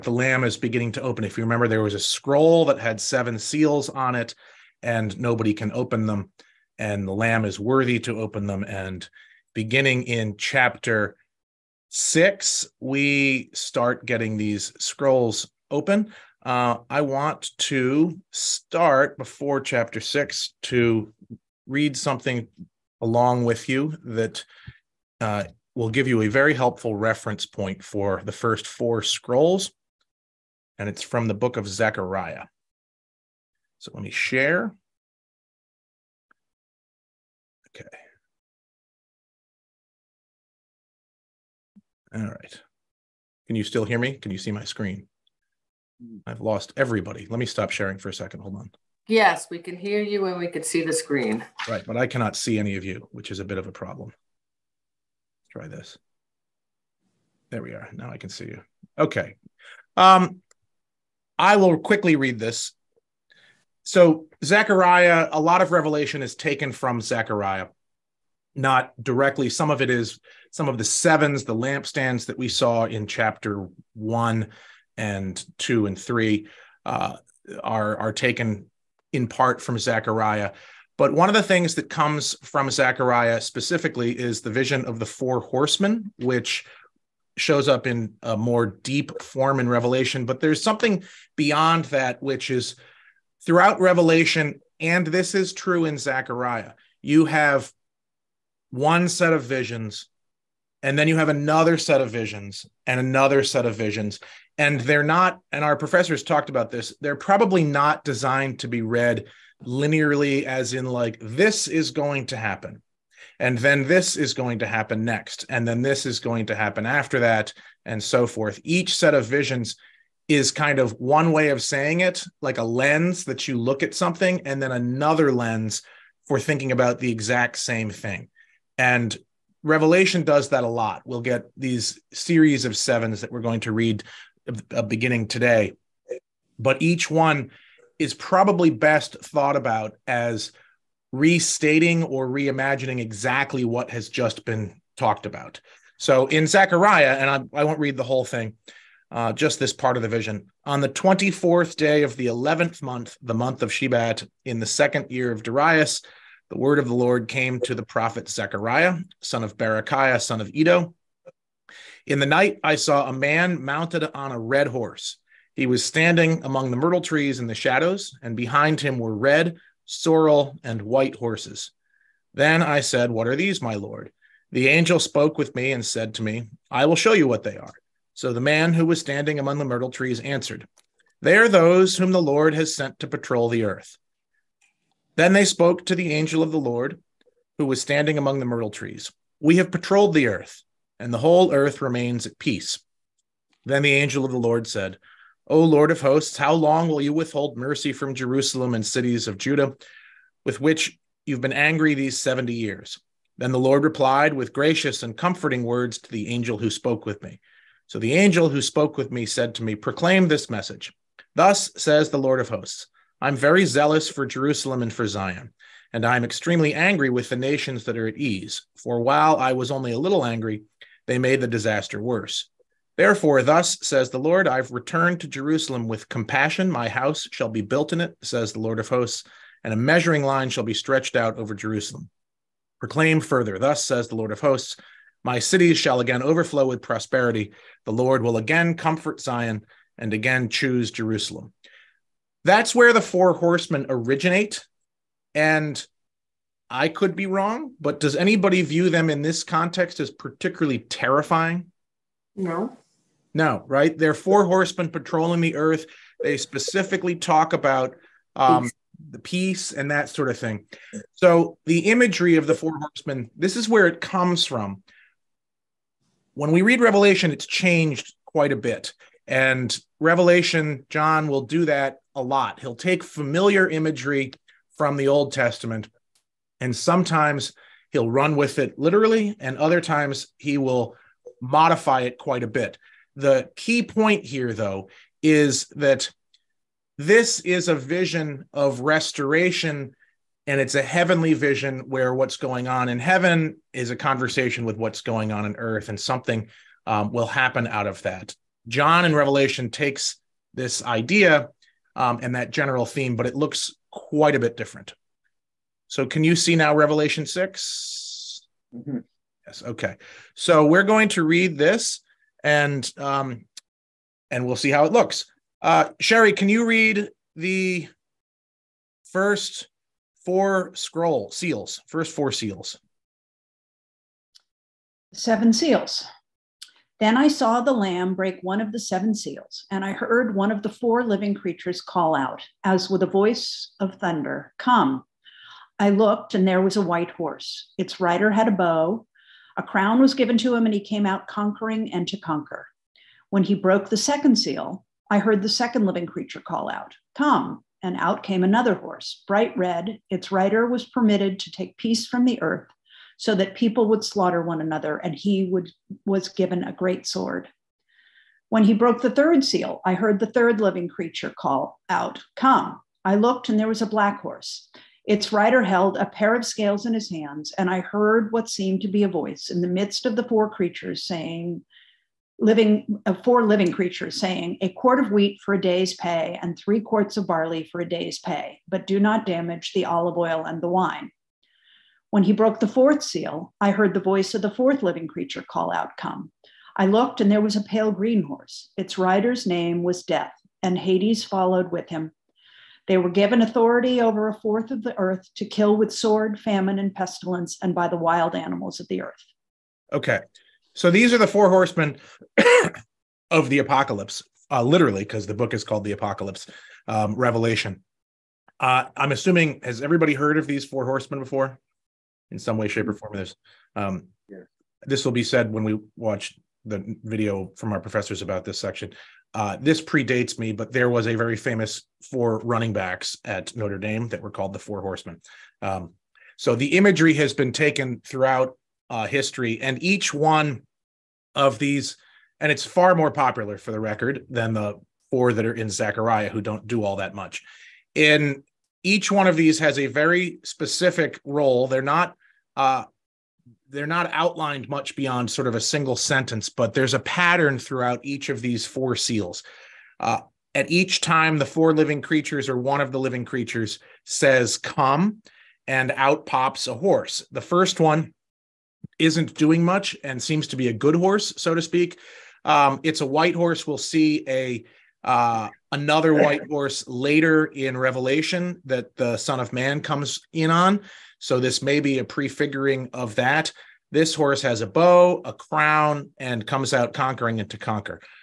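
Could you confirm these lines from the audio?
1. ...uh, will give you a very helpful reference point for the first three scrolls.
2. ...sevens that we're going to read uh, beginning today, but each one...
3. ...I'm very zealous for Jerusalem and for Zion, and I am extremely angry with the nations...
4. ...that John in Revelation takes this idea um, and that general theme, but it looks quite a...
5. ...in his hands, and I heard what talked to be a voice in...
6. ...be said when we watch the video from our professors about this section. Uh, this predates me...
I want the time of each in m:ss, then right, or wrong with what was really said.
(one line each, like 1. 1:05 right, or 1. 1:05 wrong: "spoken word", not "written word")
1. 0:25 wrong: "four", not "three"
2. 2:12 right
3. 3:33 right
4. 4:58 right
5. 6:06 wrong: "seemed", not "talked"
6. 6:55 right.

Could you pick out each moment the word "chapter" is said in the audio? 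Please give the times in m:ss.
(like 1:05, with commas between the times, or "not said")
0:10, 0:19, 1:13.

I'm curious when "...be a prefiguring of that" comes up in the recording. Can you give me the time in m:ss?
7:51.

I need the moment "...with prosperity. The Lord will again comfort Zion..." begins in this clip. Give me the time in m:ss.
3:56.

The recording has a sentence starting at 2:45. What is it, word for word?
He was standing among the myrtle trees in the shadows, and behind him were red, sorrel, and white horses.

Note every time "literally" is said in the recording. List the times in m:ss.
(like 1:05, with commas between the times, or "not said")
4:38, 6:44.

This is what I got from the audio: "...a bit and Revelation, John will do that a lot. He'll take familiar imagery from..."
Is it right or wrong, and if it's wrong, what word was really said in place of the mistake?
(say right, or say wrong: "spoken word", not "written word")
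right.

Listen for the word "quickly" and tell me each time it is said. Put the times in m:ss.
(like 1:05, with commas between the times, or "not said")
1:01.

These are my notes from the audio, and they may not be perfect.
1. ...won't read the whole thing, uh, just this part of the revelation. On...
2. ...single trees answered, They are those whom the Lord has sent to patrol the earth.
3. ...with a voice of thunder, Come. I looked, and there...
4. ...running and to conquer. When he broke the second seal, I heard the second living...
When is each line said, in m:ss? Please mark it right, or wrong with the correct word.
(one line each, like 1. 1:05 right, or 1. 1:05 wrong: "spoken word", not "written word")
1. 2:27 wrong: "vision", not "revelation"
2. 2:59 wrong: "myrtle", not "single"
3. 5:32 right
4. 5:41 wrong: "conquering", not "running".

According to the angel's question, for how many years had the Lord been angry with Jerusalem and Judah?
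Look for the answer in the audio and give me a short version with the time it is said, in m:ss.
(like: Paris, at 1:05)
70, at 3:22.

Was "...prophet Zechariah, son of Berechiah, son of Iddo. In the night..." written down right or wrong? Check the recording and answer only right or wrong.
right.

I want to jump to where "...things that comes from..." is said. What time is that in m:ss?
1:21.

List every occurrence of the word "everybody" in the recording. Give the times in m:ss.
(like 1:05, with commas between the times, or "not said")
0:46, 6:49.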